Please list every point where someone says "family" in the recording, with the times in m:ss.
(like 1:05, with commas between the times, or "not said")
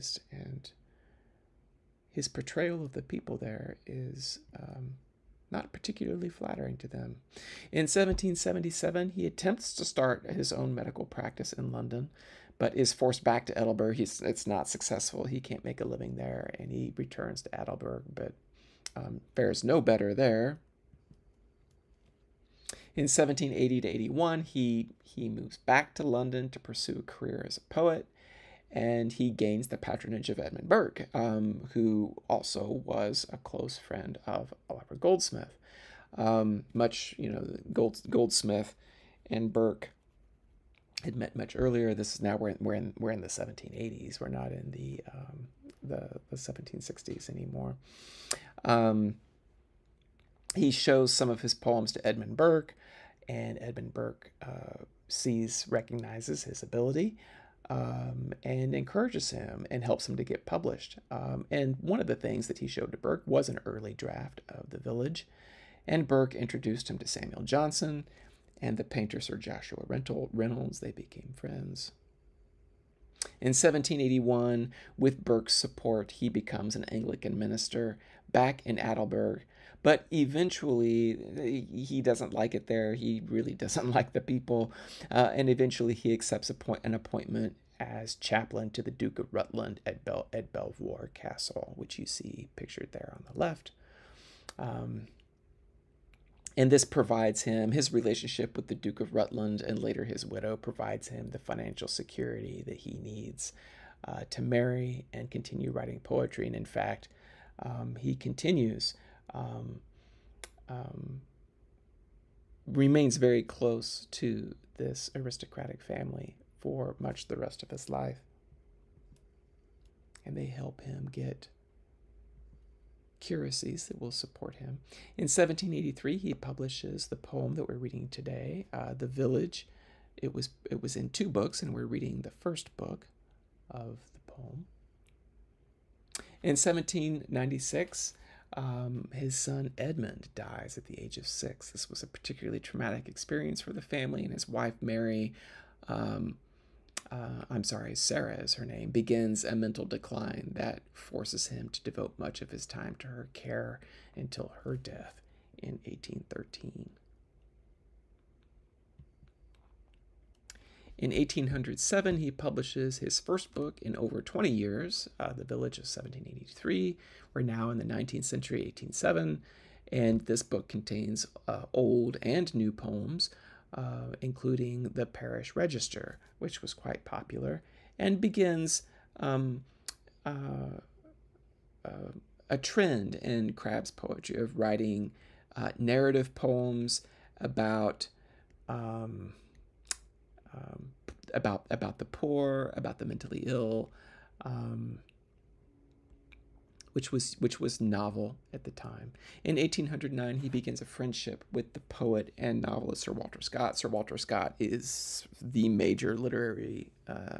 1:55, 2:23.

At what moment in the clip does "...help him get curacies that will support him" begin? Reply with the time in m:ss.
2:00.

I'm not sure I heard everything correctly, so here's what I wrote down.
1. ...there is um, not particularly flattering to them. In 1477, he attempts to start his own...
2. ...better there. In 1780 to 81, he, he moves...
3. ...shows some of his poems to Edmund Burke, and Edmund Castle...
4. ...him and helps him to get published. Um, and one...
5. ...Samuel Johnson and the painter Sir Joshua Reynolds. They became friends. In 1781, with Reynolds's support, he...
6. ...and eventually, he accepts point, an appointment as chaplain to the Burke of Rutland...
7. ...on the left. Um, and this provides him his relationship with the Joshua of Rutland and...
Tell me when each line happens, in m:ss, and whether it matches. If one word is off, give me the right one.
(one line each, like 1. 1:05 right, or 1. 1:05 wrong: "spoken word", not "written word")
1. 0:03 wrong: "1777", not "1477"
2. 0:19 right
3. 0:50 wrong: "Burke", not "Castle"
4. 0:59 right
5. 1:07 wrong: "Burke", not "Reynolds"
6. 1:25 wrong: "Duke", not "Burke"
7. 1:33 wrong: "Duke", not "Joshua".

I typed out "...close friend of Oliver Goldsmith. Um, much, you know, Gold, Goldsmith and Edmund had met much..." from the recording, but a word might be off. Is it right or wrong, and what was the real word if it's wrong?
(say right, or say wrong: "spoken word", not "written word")
wrong: "Burke", not "Edmund".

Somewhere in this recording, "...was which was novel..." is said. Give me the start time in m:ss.
3:17.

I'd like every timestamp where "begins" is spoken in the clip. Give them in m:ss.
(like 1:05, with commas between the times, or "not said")
2:28, 2:58, 3:20.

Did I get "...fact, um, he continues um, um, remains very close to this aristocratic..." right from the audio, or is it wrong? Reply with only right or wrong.
right.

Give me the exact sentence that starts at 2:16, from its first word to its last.
In 1796, um, his son Edmund dies at the age of six.